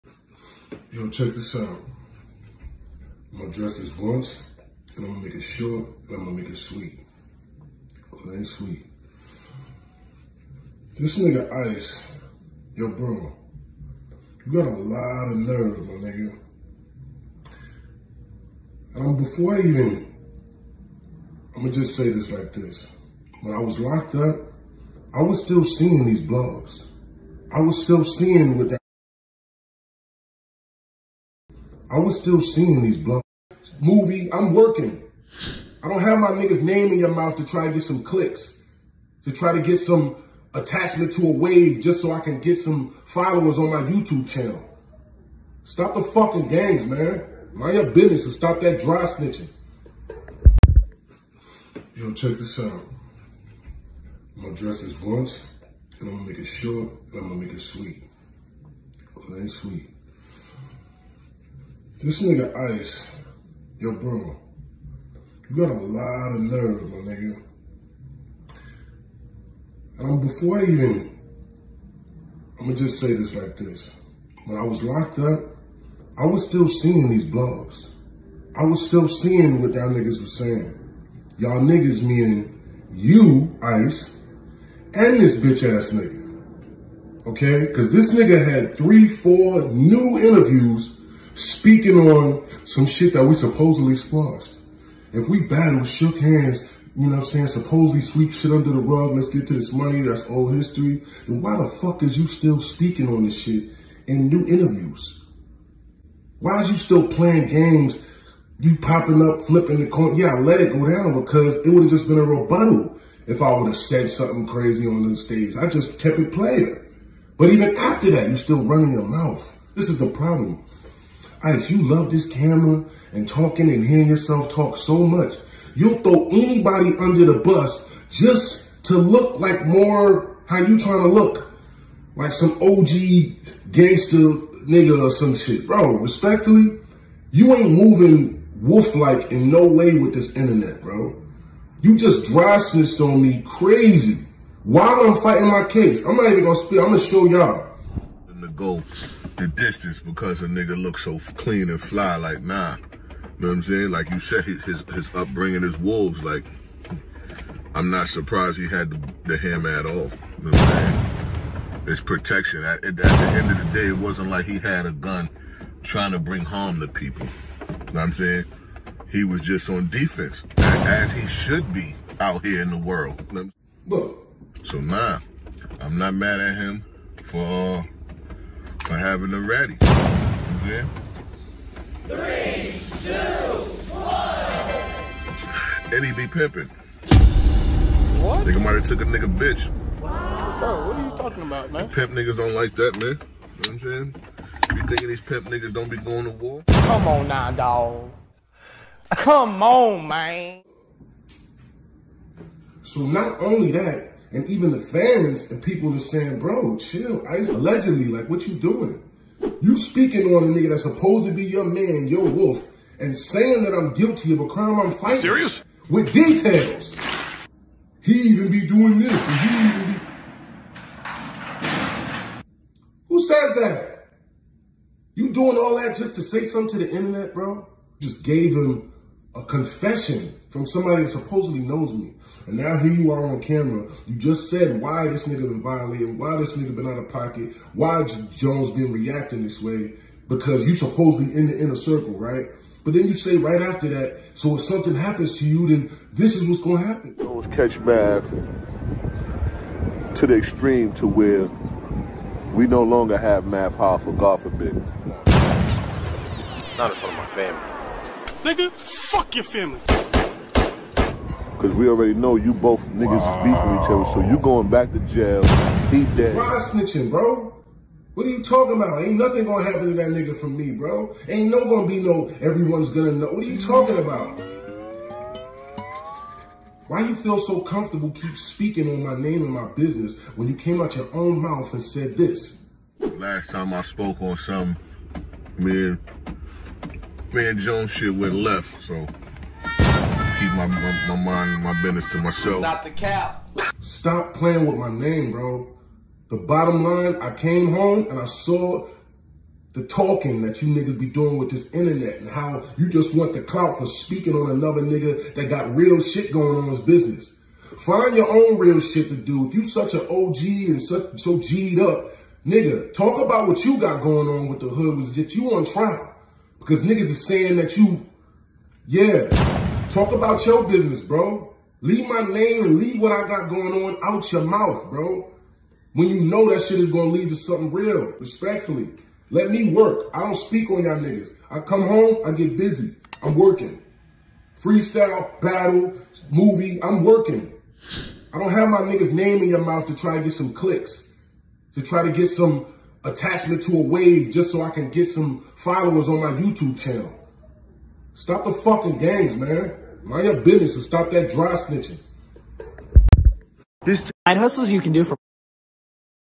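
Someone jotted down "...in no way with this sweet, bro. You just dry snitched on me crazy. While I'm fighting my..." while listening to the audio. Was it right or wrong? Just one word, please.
wrong.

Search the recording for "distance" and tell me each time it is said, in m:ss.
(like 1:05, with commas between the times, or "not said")
2:29.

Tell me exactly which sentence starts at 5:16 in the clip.
Because niggas is saying that you, yeah, talk about your business, bro.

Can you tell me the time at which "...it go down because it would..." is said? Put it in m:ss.
1:50.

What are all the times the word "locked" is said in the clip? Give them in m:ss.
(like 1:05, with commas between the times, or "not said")
0:23, 1:14.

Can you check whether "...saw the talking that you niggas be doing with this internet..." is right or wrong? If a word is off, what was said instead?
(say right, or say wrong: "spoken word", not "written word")
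right.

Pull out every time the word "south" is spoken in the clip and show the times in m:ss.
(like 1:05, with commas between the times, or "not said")
not said.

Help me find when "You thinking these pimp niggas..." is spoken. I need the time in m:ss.
3:14.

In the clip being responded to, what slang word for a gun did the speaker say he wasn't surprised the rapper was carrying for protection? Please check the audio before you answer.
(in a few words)
hammer.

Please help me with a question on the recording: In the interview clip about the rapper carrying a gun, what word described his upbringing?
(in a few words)
wolves.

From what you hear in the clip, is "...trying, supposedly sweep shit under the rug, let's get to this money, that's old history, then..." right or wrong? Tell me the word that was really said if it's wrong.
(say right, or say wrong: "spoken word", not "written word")
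wrong: "saying", not "trying".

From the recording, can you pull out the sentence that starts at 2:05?
You'll throw anybody under the bus just to look like more how you trying to look.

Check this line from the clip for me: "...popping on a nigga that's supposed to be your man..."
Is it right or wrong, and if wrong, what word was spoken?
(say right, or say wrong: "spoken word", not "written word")
wrong: "speaking", not "popping".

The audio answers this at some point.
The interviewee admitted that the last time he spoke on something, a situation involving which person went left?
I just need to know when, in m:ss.
4:47.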